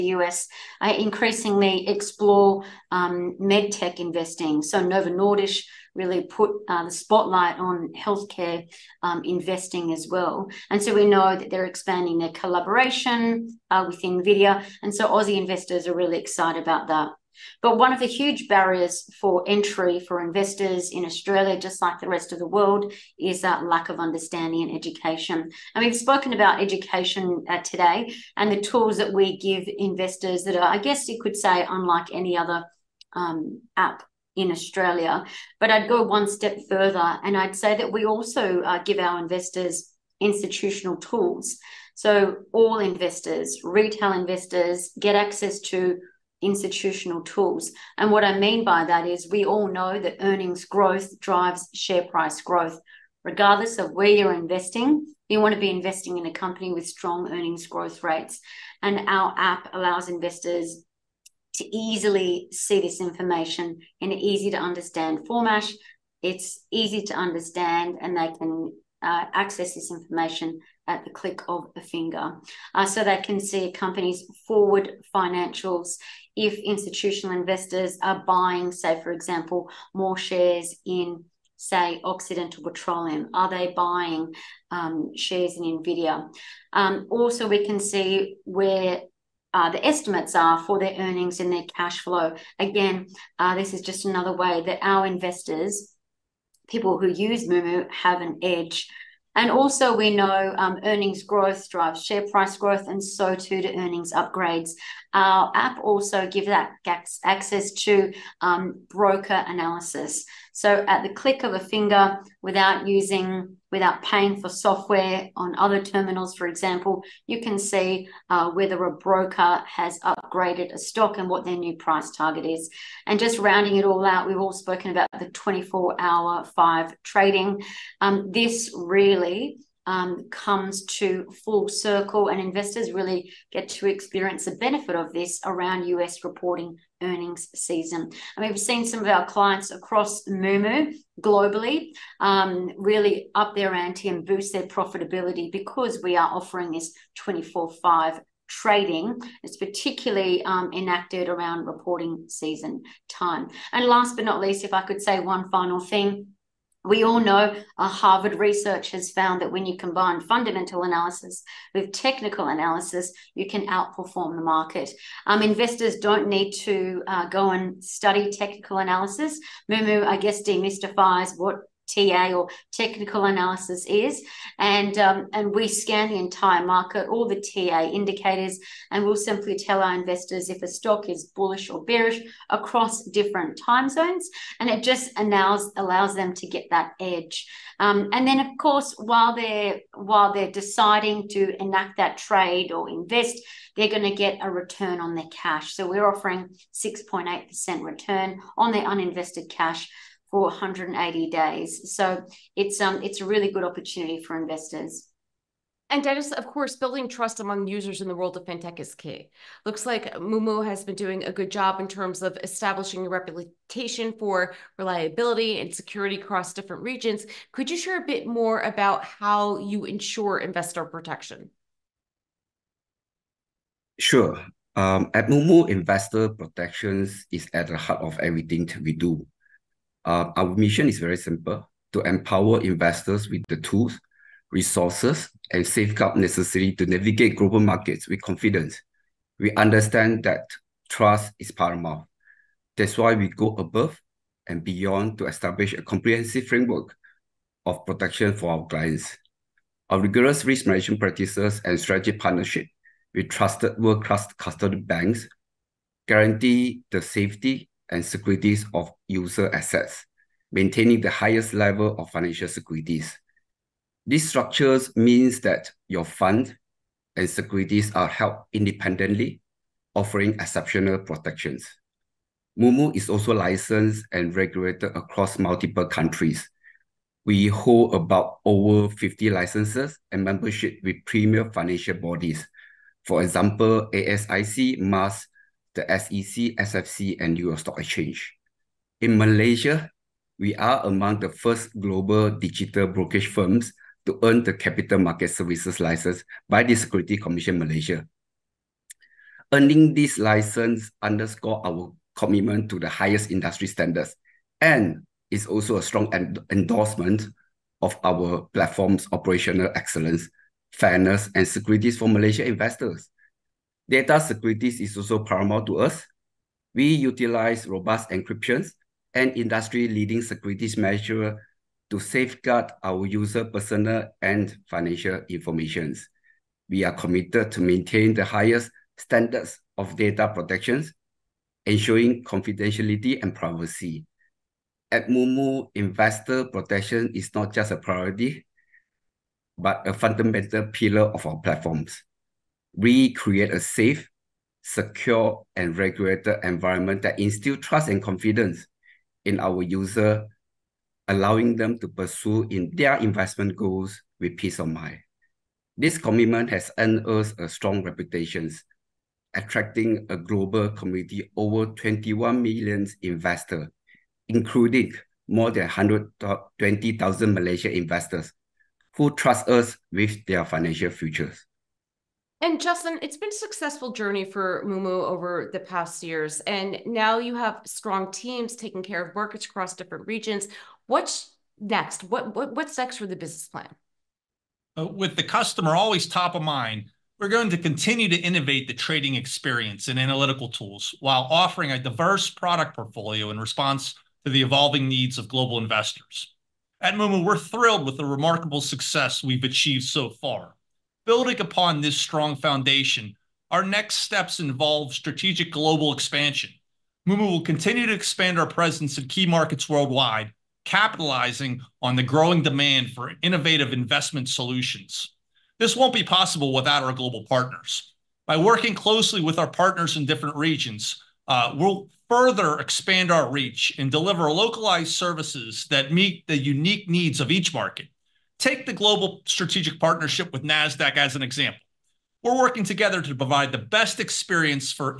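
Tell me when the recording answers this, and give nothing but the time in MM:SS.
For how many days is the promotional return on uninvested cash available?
03:20.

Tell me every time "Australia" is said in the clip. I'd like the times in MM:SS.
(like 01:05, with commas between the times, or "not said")
00:21, 00:34.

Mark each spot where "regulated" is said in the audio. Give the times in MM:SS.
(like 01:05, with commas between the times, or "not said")
04:34, 05:45.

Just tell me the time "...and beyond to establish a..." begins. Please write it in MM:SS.
04:04.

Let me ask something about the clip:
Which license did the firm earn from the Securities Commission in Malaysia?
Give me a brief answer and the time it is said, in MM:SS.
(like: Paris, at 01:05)
Capital Market Services license, at 04:54.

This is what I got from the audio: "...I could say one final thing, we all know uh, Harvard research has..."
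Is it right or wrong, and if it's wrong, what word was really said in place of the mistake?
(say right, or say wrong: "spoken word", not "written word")
right.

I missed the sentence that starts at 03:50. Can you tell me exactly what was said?
Uh, our mission is very simple to empower investors with the tools, resources, and safeguard necessary to navigate global markets with confidence.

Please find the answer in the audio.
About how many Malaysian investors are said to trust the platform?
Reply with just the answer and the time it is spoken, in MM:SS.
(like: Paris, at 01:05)
120,000, at 06:05.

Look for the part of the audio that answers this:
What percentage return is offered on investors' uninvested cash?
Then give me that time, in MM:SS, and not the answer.
03:16.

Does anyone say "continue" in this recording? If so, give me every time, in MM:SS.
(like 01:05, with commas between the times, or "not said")
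06:27, 06:47.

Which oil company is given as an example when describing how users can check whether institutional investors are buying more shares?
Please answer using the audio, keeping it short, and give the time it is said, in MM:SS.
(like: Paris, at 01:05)
Occidental Petroleum, at 01:22.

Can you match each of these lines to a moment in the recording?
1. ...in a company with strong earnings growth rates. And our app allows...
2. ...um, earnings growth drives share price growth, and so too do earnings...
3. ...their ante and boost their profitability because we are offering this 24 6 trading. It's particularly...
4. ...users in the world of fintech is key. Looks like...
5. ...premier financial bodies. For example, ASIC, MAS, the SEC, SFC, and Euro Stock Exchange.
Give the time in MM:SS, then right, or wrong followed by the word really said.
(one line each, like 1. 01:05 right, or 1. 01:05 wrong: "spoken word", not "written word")
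1. 00:56 right
2. 01:40 right
3. 02:23 wrong: "5", not "6"
4. 03:27 right
5. 04:41 right.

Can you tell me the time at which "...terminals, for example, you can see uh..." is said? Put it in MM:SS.
01:55.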